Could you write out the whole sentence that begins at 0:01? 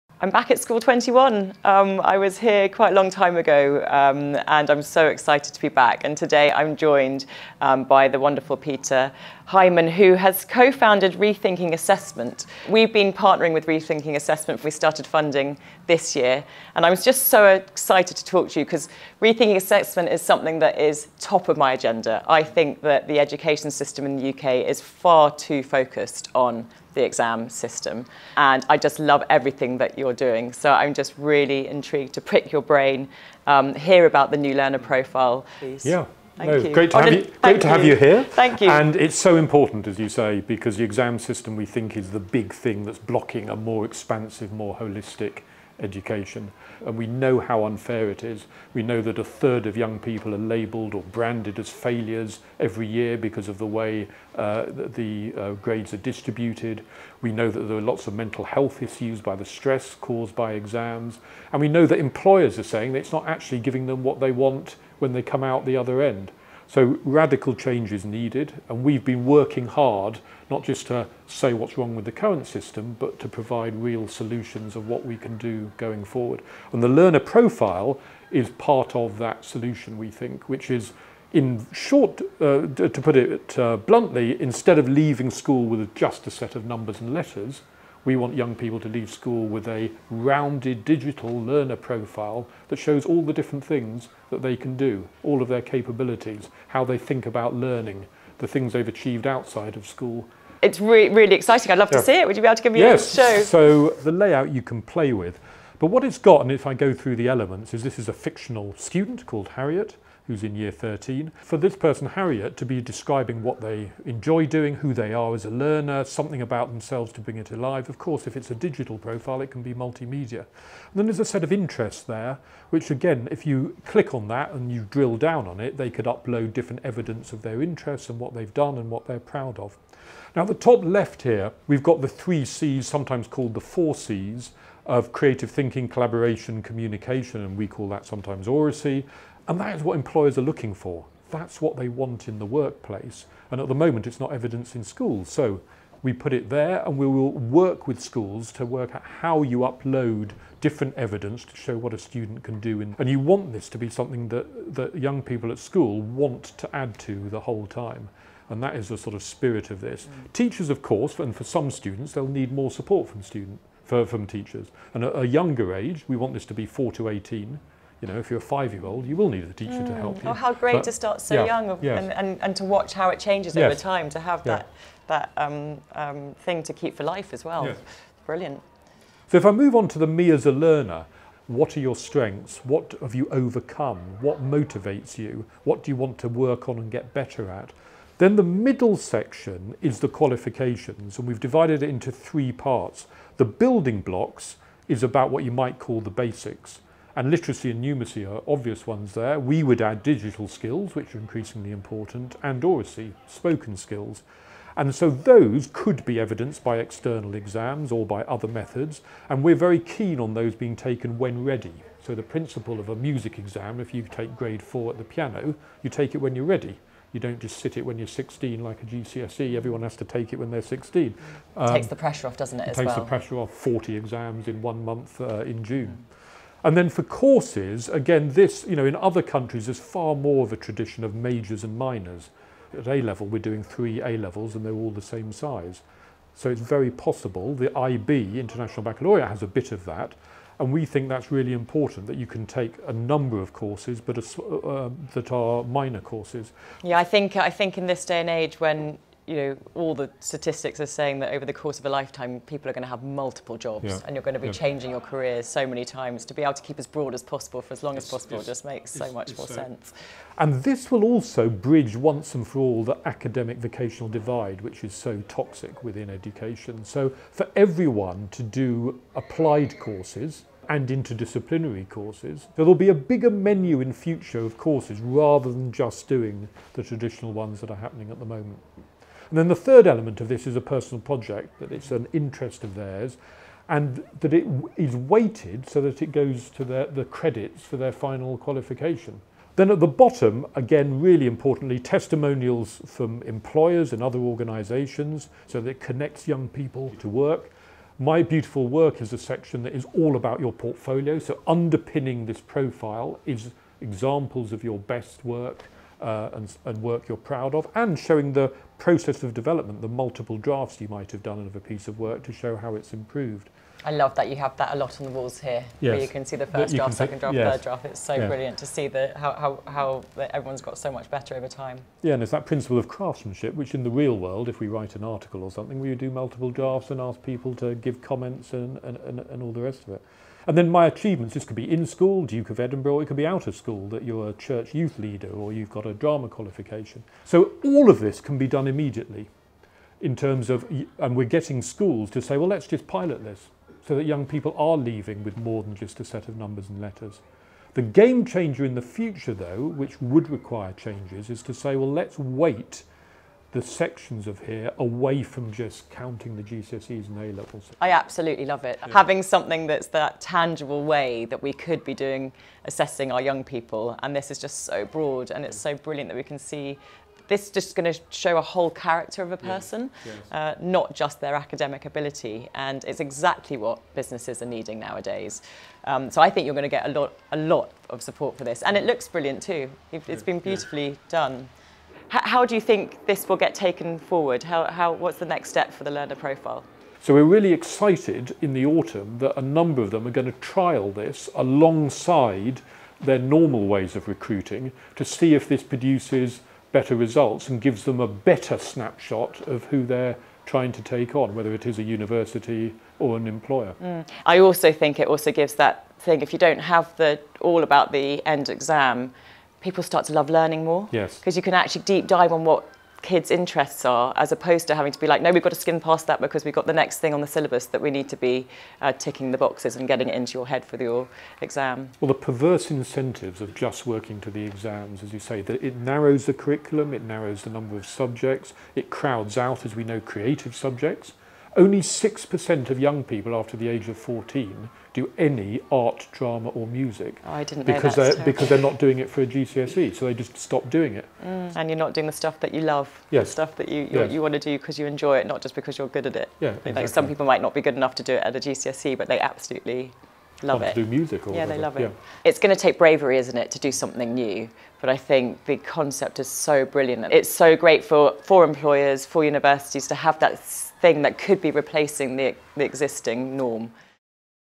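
Um, I was here quite a long time ago um, and I'm so excited to be back.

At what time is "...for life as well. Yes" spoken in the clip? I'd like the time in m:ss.
2:56.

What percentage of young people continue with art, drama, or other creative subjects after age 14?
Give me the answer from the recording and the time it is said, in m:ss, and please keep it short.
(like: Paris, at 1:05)
6%, at 7:11.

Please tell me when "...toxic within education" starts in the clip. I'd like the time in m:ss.
4:25.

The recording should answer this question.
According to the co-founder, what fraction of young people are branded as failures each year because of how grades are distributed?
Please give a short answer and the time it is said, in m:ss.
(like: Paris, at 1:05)
a third, at 0:49.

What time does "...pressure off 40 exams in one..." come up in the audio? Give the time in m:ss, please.
3:43.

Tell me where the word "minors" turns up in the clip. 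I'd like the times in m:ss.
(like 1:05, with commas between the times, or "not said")
3:51, 4:05.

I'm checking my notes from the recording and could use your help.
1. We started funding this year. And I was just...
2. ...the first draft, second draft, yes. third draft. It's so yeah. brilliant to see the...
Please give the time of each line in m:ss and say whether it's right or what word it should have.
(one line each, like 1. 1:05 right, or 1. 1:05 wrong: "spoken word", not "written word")
1. 0:14 right
2. 5:16 right.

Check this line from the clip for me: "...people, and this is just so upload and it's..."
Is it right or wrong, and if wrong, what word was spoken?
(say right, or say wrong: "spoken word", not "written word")
wrong: "broad", not "upload".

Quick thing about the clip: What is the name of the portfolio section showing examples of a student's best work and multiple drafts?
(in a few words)
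My Beautiful Work.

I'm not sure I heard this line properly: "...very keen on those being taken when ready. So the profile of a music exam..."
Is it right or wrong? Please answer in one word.
wrong.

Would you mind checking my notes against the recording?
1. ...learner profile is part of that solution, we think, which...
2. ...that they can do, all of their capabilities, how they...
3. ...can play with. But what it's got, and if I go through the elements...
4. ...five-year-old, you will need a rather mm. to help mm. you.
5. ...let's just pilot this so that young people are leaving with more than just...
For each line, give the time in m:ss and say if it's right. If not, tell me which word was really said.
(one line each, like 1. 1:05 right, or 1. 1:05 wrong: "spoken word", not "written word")
1. 1:16 right
2. 1:34 right
3. 1:44 right
4. 2:48 wrong: "teacher", not "rather"
5. 5:42 right.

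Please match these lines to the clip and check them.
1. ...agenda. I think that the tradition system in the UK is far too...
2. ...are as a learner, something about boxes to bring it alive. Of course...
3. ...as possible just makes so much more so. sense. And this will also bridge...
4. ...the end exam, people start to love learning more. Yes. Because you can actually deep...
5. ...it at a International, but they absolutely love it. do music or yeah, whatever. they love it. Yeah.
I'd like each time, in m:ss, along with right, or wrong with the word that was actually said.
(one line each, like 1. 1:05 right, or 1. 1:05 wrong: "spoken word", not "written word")
1. 0:21 wrong: "education", not "tradition"
2. 1:55 wrong: "themselves", not "boxes"
3. 4:18 right
4. 6:47 right
5. 7:28 wrong: "GCSE", not "International".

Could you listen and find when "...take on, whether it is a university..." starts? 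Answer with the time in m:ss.
6:40.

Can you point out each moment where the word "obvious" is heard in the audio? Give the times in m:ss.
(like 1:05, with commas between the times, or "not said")
3:18.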